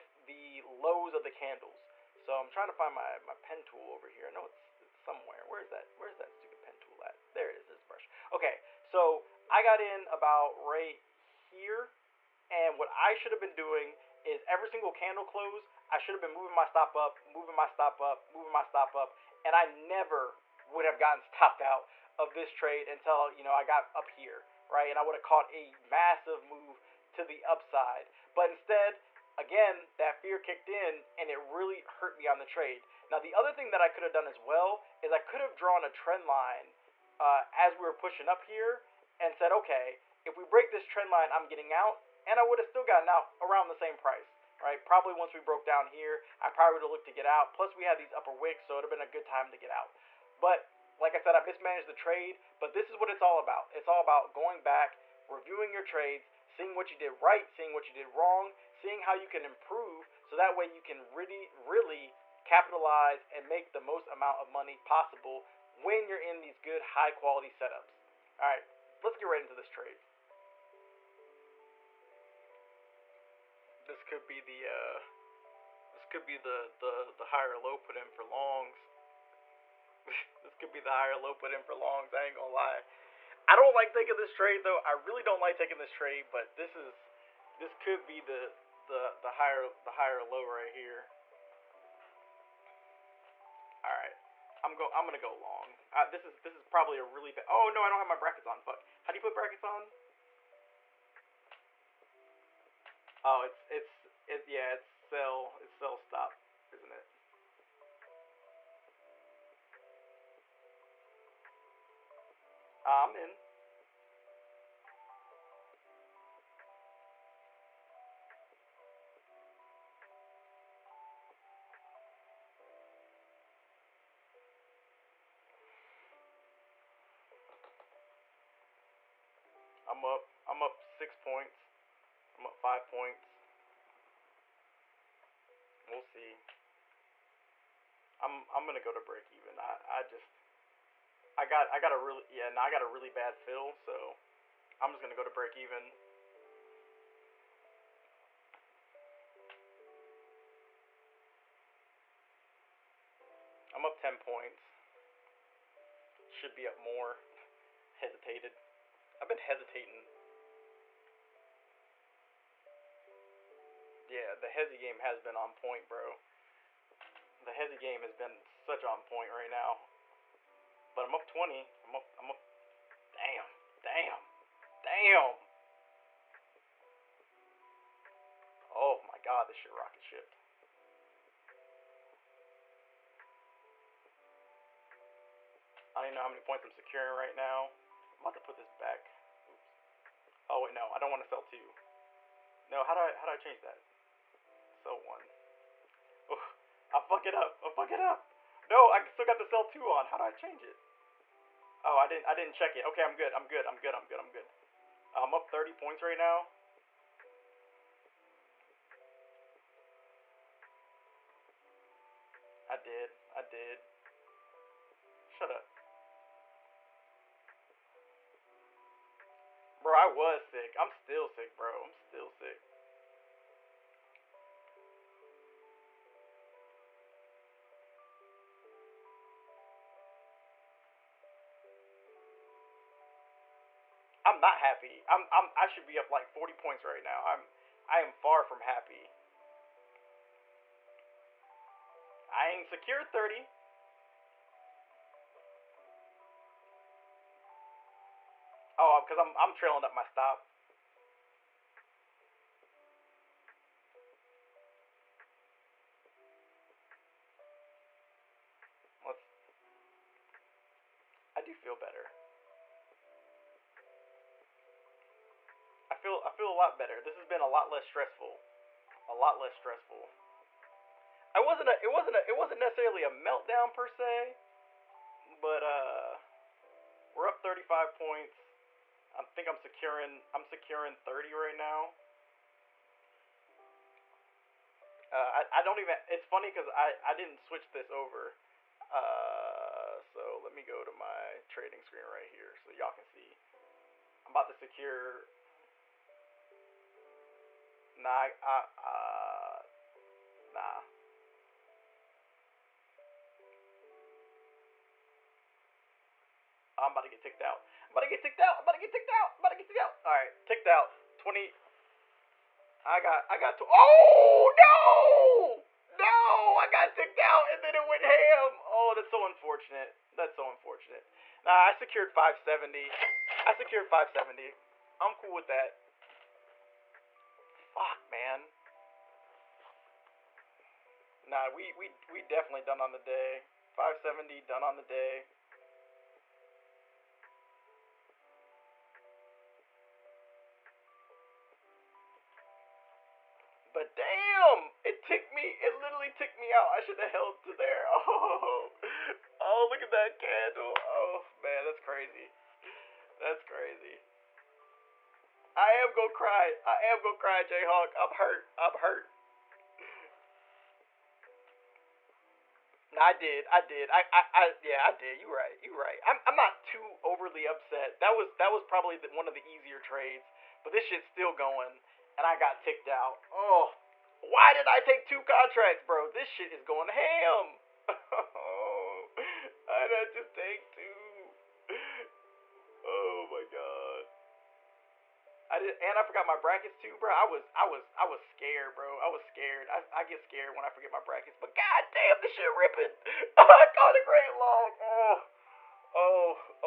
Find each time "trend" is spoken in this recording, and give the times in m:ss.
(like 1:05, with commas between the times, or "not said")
0:35, 0:40.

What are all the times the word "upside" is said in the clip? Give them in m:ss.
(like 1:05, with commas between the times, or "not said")
0:27.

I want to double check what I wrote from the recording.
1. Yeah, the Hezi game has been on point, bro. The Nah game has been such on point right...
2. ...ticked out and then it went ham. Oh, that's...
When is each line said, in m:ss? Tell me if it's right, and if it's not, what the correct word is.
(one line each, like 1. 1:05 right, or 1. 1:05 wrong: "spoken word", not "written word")
1. 2:44 wrong: "Hezi", not "Nah"
2. 5:16 right.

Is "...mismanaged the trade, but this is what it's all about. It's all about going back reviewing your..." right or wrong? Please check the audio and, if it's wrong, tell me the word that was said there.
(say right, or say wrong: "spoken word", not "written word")
right.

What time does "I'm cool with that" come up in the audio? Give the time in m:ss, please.
5:24.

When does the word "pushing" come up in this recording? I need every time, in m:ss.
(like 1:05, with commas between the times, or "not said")
0:37.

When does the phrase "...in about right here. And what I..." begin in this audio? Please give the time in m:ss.
0:09.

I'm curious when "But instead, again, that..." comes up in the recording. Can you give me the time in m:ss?
0:28.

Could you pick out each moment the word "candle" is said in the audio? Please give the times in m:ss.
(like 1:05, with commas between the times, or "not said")
0:01, 0:14, 5:50.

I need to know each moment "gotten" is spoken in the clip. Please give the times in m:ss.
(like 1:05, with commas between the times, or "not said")
0:20, 0:42.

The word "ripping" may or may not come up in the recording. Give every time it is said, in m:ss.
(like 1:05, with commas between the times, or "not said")
6:32.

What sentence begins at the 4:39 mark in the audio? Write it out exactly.
I think I'm securing I'm securing 30 right now.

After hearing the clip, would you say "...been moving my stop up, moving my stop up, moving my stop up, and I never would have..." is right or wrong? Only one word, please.
right.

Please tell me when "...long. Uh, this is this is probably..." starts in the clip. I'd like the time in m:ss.
1:35.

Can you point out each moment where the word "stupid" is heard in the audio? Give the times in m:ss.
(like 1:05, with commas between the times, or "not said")
0:06.